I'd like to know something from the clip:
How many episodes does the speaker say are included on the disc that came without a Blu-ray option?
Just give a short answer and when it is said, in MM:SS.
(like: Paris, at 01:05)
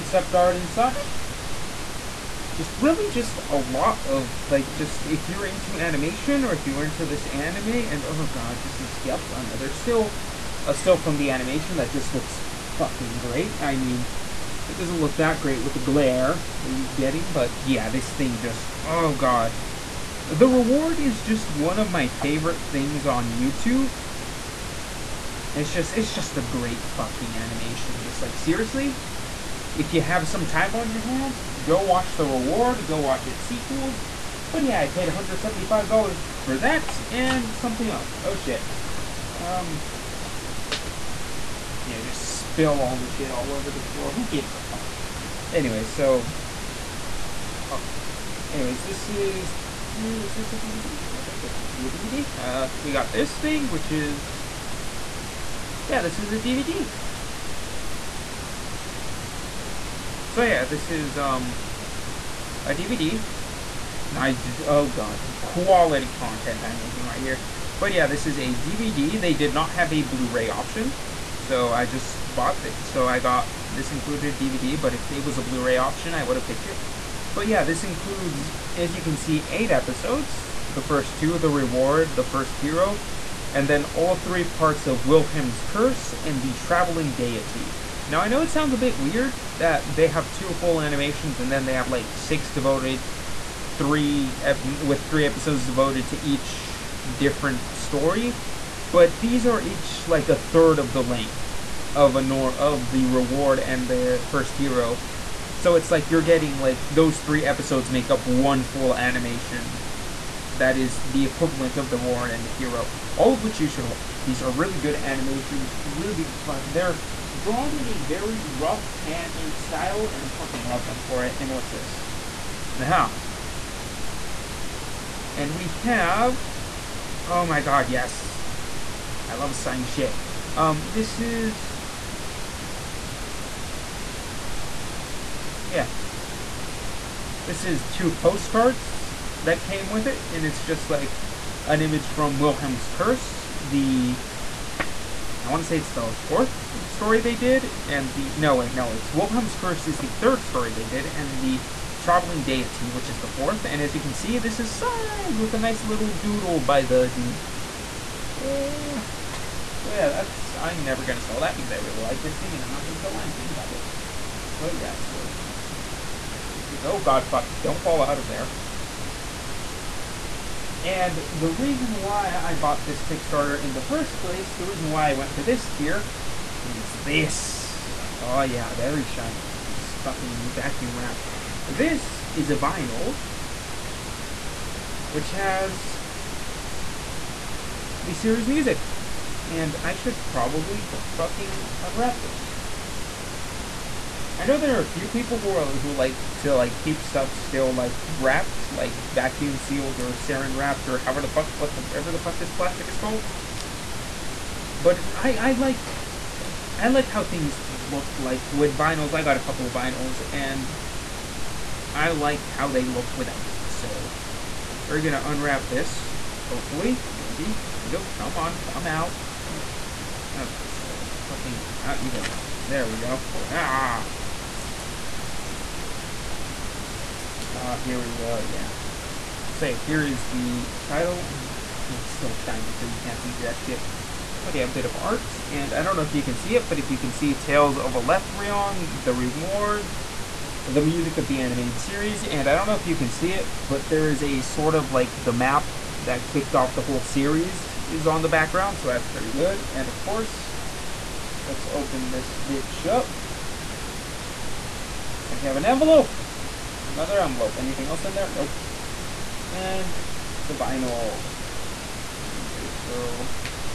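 8, at 01:19.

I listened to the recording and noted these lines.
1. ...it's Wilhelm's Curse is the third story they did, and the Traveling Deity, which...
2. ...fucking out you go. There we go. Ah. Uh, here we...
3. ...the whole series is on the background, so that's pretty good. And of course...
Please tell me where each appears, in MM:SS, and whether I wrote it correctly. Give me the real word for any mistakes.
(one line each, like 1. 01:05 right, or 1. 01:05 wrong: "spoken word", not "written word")
1. 02:28 right
2. 03:41 right
3. 04:06 right.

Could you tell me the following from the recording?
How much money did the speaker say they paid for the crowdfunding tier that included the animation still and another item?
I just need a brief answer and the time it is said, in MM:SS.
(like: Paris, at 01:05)
$175, at 00:35.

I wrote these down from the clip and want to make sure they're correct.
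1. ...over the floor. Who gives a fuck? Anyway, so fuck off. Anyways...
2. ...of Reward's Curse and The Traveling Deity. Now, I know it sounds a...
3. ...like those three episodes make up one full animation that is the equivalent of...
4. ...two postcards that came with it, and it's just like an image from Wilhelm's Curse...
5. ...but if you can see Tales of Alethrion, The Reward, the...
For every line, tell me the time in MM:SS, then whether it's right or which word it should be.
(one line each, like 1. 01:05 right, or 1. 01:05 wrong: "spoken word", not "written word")
1. 00:43 right
2. 01:24 wrong: "Wilhelm", not "Reward"
3. 01:46 right
4. 02:17 right
5. 03:56 right.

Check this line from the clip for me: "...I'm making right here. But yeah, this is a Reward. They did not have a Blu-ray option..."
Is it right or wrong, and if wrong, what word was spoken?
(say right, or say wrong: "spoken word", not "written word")
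wrong: "DVD", not "Reward".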